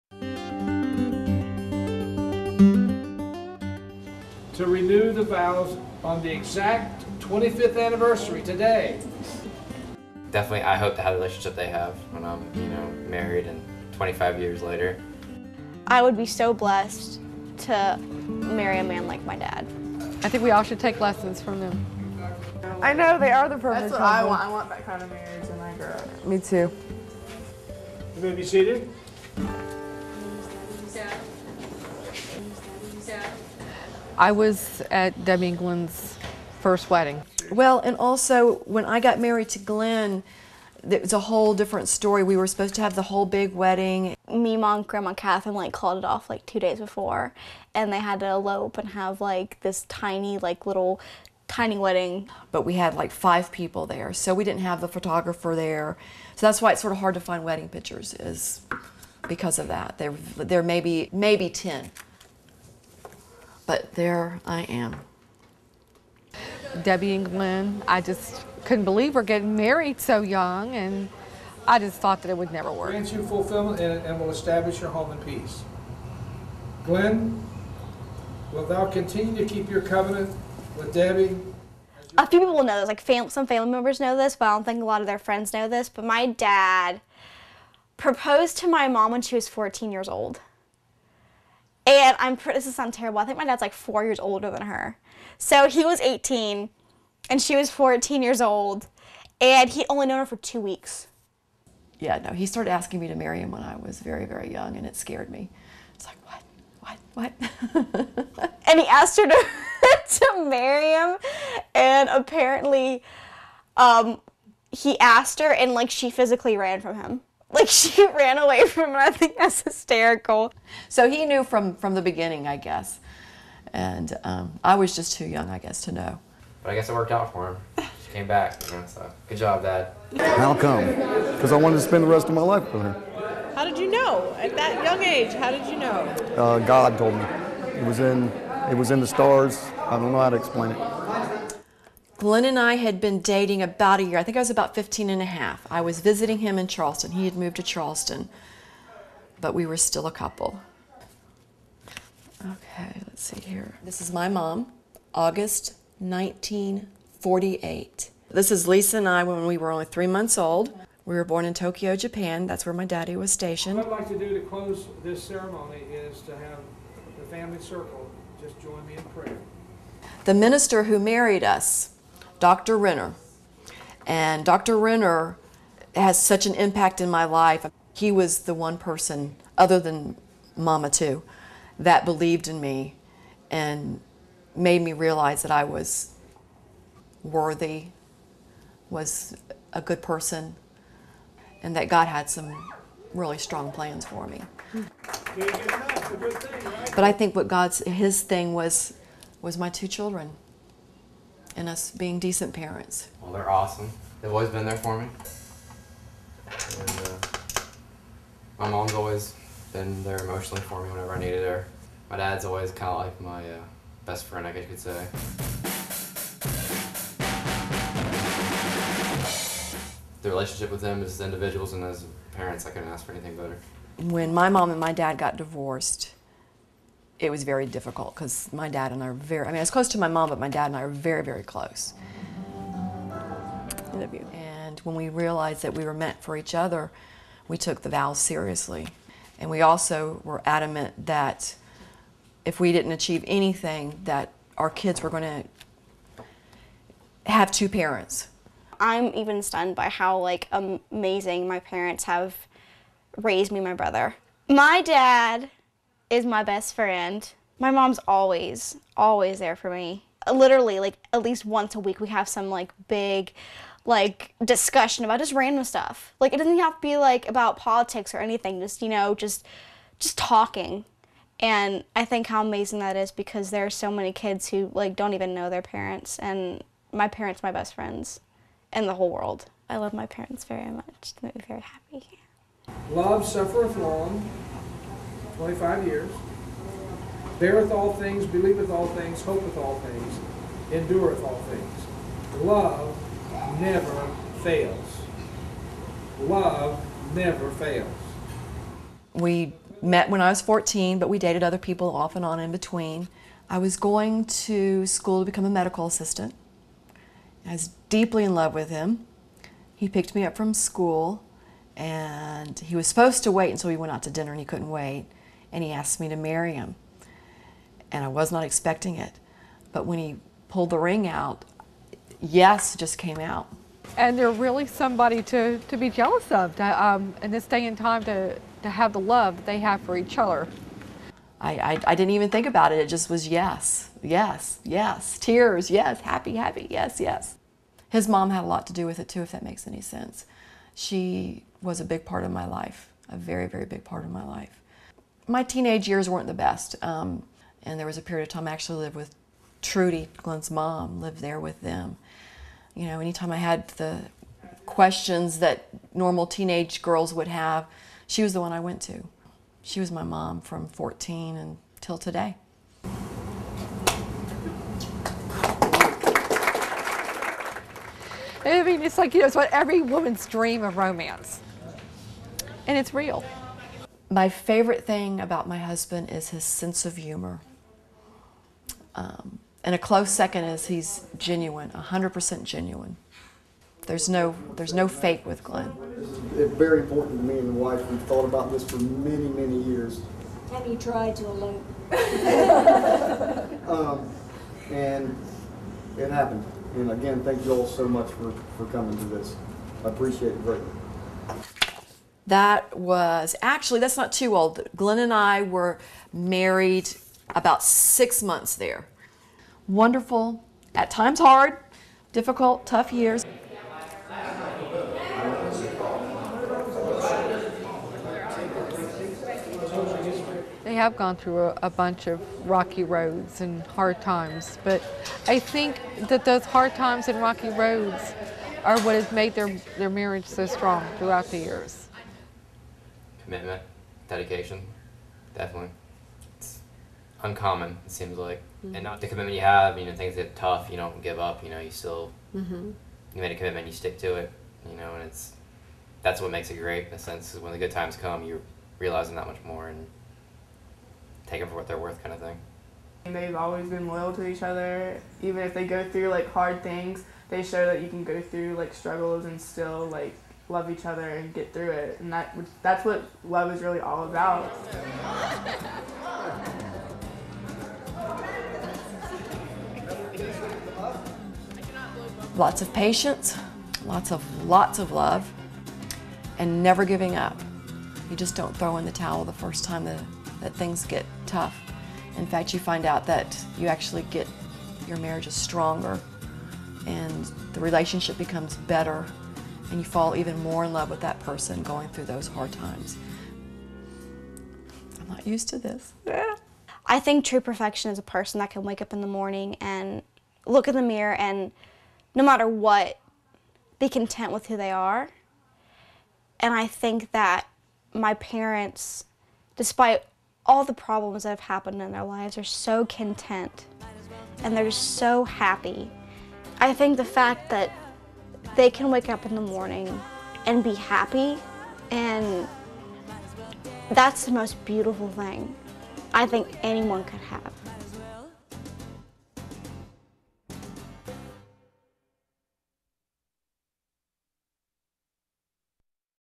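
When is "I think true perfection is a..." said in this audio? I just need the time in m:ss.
8:16.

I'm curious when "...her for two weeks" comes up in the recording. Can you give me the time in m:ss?
1:40.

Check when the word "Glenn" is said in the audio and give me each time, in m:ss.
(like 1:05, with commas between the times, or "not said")
0:35, 0:39, 1:07, 1:16, 2:22, 5:50, 6:25, 6:44.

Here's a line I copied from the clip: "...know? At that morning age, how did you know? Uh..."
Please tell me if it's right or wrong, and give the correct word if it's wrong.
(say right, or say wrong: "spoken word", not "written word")
wrong: "young", not "morning".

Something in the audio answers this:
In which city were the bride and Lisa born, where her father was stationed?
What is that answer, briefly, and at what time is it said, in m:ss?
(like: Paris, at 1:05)
Tokyo, Japan, at 2:41.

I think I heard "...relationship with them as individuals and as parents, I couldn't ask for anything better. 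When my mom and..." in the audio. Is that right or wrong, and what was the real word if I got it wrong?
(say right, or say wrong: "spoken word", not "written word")
right.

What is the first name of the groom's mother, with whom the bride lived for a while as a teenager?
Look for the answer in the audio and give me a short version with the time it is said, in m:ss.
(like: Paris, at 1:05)
Trudy, at 5:49.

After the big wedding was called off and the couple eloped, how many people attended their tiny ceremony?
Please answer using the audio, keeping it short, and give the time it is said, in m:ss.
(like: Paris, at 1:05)
5, at 0:53.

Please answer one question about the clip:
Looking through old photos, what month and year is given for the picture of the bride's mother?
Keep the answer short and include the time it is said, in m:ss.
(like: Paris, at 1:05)
August 1948, at 2:35.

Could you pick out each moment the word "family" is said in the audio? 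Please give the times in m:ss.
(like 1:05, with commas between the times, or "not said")
1:23, 2:47.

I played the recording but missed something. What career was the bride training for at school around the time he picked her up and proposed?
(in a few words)
Medical assistant.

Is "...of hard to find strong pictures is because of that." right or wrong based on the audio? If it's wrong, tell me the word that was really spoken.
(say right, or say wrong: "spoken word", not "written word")
wrong: "wedding", not "strong".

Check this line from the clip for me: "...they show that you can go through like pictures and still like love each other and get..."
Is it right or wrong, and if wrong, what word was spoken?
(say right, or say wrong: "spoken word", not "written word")
wrong: "struggles", not "pictures".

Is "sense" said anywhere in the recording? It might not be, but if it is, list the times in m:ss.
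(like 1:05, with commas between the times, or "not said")
5:39, 6:16, 7:26.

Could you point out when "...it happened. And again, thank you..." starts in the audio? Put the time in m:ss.
6:35.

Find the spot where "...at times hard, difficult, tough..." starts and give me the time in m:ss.
6:50.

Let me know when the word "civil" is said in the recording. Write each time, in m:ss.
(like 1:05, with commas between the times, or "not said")
not said.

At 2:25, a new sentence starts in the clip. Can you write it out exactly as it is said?
I was visiting him in Charleston.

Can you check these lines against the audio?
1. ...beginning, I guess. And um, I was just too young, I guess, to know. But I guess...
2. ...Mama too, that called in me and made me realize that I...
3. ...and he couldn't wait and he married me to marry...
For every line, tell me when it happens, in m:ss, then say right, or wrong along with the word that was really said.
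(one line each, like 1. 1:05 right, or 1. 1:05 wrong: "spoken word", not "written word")
1. 2:02 right
2. 3:00 wrong: "believed", not "called"
3. 5:14 wrong: "asked", not "married".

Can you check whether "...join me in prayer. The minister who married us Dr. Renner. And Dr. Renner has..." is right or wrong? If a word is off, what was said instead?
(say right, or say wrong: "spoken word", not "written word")
right.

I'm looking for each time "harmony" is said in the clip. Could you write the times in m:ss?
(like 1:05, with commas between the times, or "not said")
not said.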